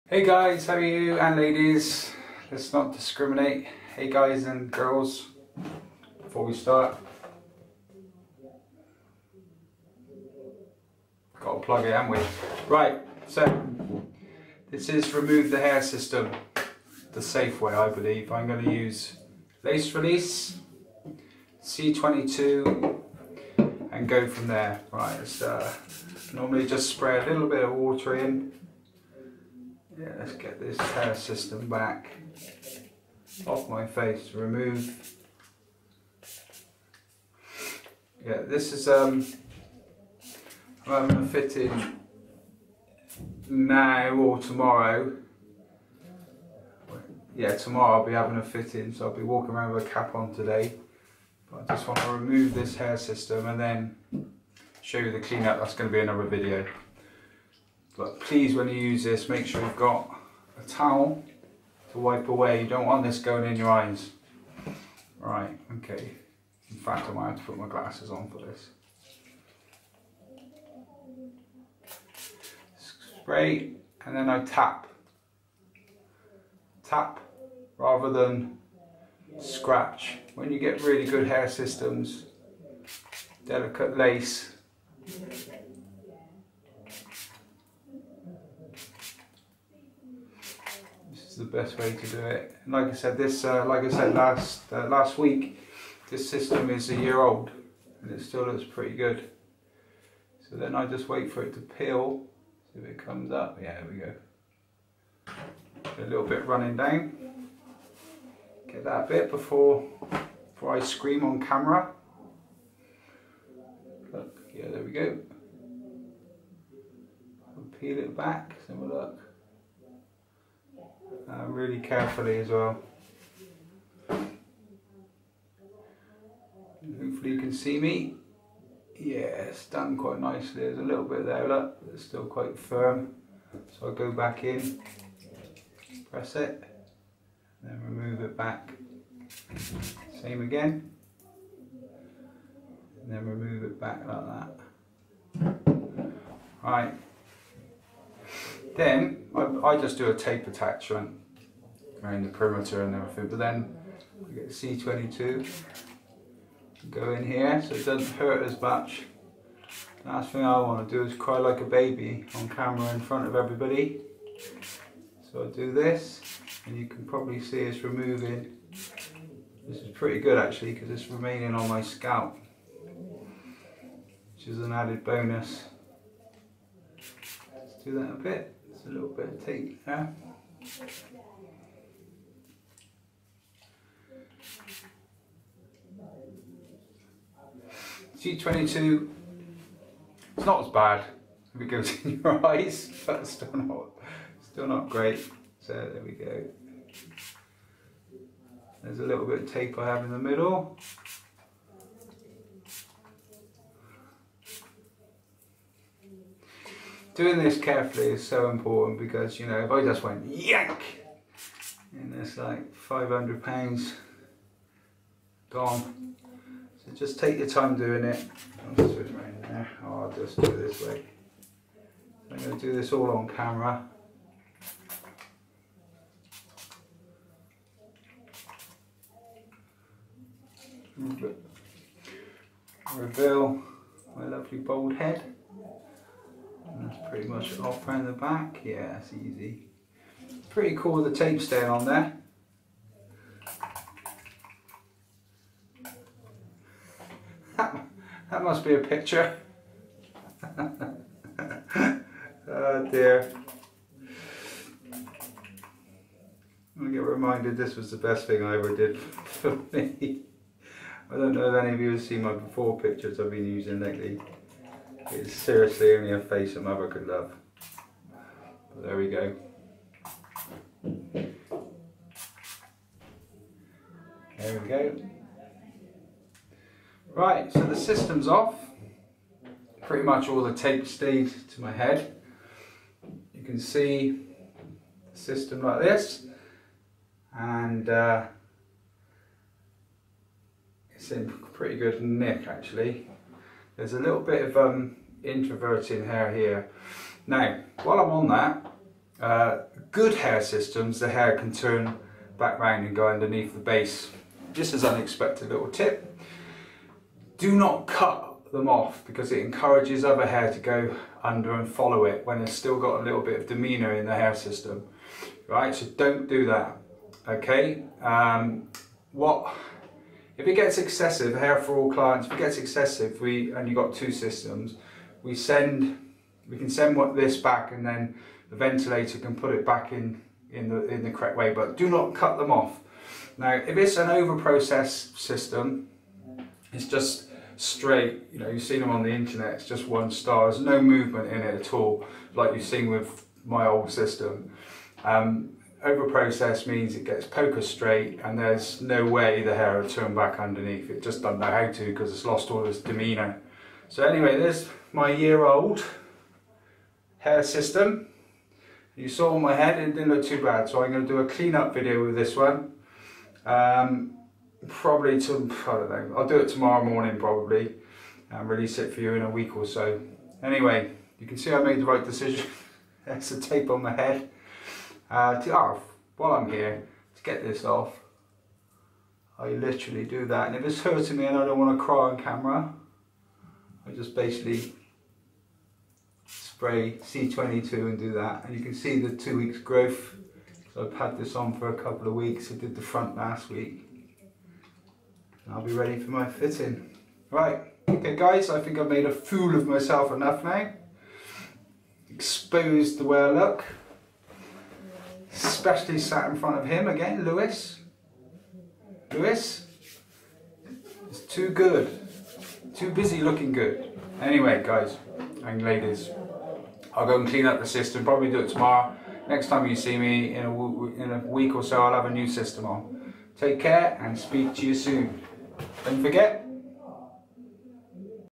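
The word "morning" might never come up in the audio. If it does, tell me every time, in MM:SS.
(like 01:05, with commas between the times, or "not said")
06:06.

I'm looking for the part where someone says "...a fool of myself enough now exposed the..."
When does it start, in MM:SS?
06:39.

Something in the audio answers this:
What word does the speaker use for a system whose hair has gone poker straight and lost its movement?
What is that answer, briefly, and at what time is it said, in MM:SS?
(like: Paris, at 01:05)
Overprocess, at 05:45.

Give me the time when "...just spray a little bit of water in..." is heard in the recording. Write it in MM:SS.
00:26.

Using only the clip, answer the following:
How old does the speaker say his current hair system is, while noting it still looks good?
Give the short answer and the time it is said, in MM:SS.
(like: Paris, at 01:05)
a year old, at 01:36.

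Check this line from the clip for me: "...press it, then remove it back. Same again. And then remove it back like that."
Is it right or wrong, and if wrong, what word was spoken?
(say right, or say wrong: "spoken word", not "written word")
right.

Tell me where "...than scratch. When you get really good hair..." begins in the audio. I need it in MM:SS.
01:18.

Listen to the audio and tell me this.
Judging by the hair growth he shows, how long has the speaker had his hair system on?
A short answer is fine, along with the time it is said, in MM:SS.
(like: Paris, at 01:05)
two weeks, at 06:29.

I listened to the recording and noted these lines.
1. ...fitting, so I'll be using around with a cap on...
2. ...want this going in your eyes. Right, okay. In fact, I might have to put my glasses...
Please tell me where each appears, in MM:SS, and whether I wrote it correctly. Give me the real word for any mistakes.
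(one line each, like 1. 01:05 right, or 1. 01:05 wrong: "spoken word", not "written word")
1. 00:48 wrong: "walking", not "using"
2. 01:02 right.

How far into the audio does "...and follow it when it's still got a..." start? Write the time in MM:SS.
05:11.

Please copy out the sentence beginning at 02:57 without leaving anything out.
Let's do that a bit a little bit of teeth there.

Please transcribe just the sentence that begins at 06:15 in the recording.
Uh, to, oh, while I'm here, to get this off, I literally do that.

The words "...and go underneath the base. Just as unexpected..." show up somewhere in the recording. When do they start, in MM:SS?
05:02.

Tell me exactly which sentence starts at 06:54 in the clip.
Anyway, guys and ladies, I'll go and clean up the system.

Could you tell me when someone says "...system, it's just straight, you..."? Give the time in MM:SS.
05:35.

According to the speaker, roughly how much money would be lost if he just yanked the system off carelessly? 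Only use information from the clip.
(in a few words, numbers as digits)
500 pounds.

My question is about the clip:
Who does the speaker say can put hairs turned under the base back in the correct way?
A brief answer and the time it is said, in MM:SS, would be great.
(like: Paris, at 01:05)
the ventilator, at 05:28.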